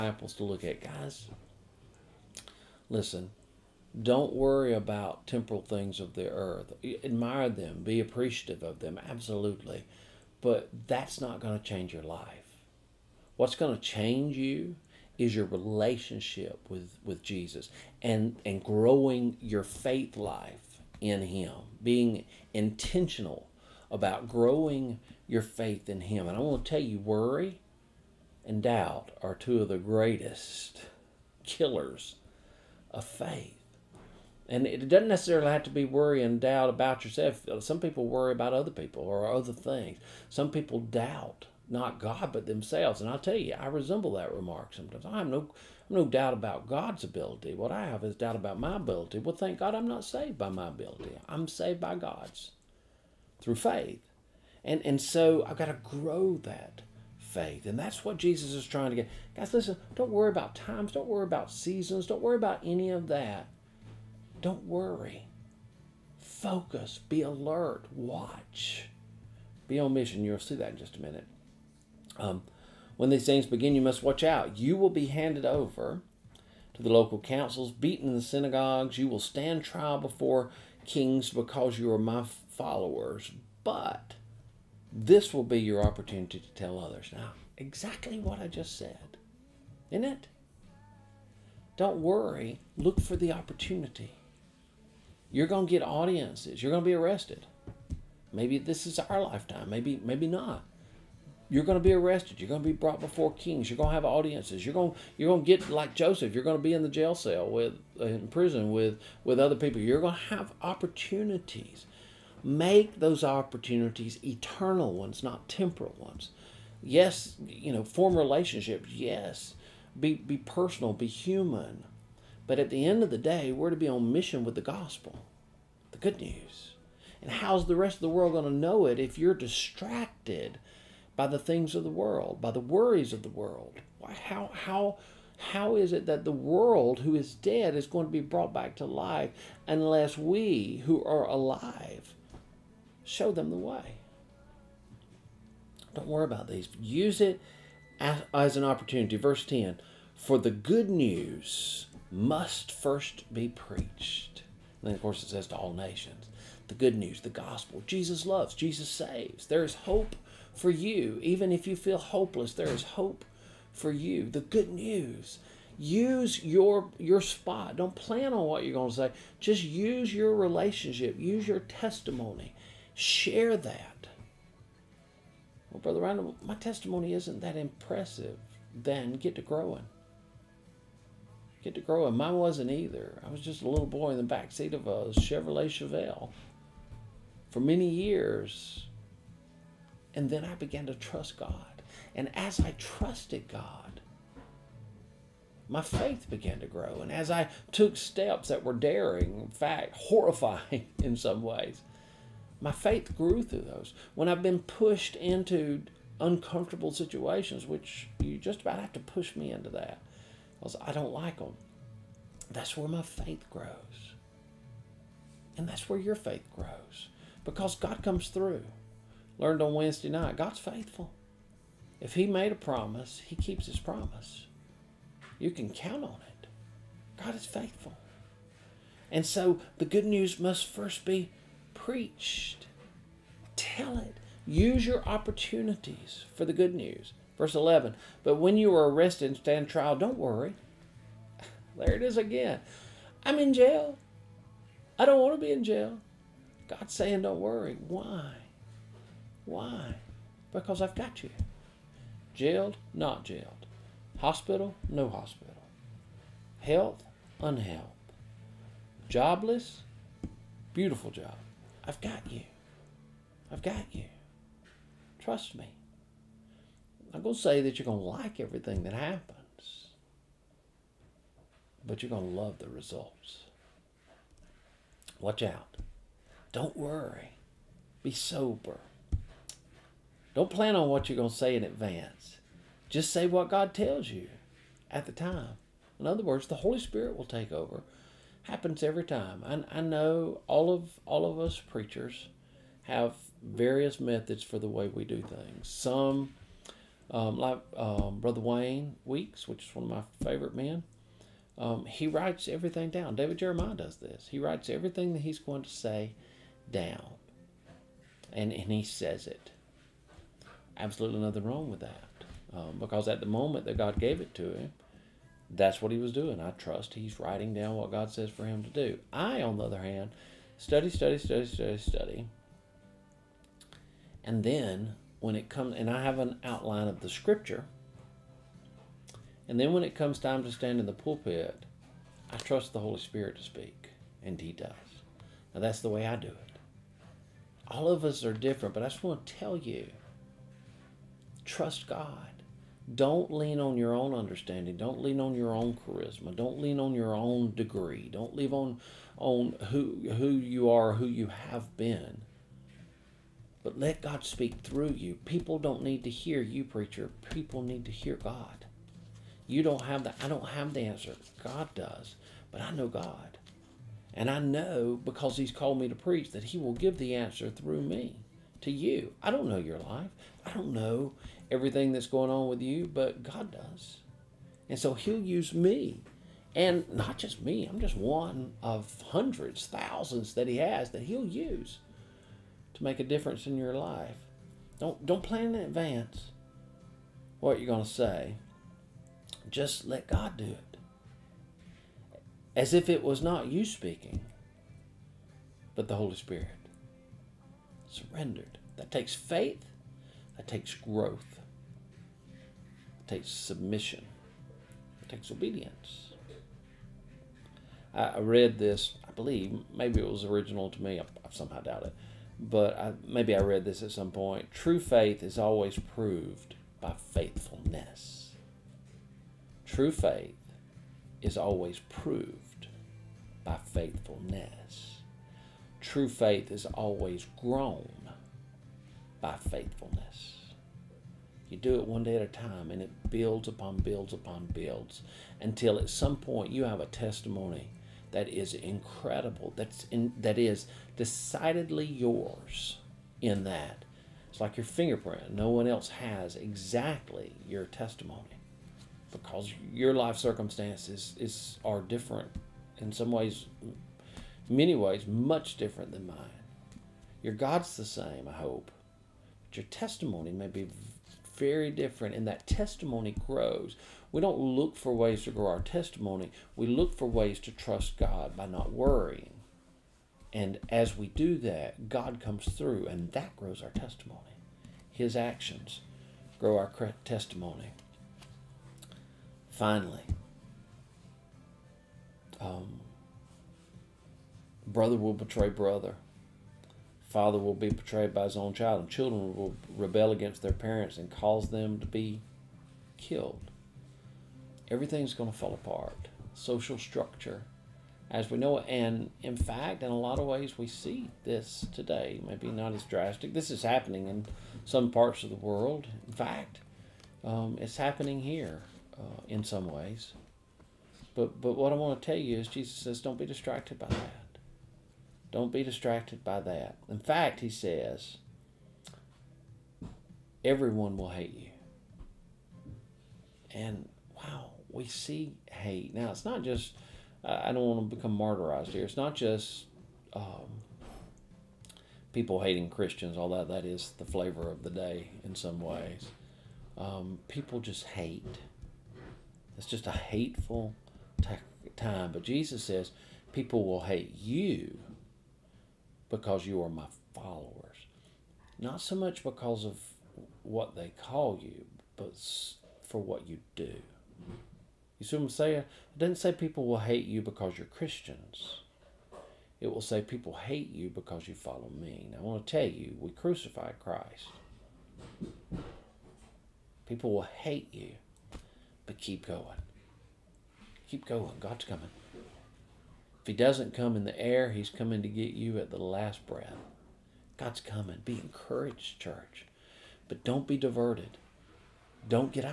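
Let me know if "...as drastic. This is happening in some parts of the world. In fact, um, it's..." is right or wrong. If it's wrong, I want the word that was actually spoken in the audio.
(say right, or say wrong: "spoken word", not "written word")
right.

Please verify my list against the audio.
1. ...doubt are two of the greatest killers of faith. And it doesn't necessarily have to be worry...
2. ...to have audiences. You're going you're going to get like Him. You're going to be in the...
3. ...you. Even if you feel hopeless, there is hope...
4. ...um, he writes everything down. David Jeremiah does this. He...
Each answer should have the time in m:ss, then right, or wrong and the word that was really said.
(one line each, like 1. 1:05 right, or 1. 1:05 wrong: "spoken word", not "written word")
1. 0:28 right
2. 1:43 wrong: "Joseph", not "Him"
3. 2:40 right
4. 5:01 right.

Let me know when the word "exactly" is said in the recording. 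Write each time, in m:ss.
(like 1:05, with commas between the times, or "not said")
1:27, 7:26.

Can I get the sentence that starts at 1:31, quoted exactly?
Don't worry, look for the opportunity.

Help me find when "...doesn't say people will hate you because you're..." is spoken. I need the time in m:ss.
9:15.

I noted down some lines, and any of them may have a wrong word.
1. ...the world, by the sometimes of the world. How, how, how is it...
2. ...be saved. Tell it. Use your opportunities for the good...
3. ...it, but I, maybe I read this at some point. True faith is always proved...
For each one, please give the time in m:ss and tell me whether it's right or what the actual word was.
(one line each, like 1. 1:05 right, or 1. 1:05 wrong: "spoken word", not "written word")
1. 2:11 wrong: "worries", not "sometimes"
2. 3:51 wrong: "preached", not "saved"
3. 6:51 right.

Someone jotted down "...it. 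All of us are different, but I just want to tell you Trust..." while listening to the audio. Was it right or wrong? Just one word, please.
right.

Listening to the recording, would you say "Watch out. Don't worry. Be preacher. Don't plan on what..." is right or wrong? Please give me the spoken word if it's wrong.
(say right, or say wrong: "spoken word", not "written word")
wrong: "sober", not "preacher".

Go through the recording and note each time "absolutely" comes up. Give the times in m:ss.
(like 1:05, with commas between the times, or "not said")
0:09, 5:10.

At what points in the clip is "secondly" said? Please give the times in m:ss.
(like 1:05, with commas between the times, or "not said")
not said.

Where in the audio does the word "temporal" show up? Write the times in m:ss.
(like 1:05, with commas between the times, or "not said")
0:05, 1:55.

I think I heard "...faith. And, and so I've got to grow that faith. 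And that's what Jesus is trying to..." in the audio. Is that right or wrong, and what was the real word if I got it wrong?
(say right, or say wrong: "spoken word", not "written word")
right.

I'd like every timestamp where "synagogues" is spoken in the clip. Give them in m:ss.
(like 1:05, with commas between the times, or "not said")
1:18.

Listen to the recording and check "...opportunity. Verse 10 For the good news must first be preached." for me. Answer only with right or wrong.
right.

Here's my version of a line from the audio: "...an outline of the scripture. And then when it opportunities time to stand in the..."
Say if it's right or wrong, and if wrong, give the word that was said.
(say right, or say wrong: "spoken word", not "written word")
wrong: "comes", not "opportunities".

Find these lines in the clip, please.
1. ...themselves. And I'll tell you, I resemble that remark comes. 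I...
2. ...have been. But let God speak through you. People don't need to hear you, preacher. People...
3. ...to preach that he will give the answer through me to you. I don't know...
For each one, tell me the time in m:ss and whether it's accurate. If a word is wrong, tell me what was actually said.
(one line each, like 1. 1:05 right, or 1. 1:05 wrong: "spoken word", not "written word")
1. 0:42 wrong: "sometimes", not "comes"
2. 5:51 right
3. 6:05 right.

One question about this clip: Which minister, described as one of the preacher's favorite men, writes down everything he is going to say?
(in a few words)
Wayne Weeks.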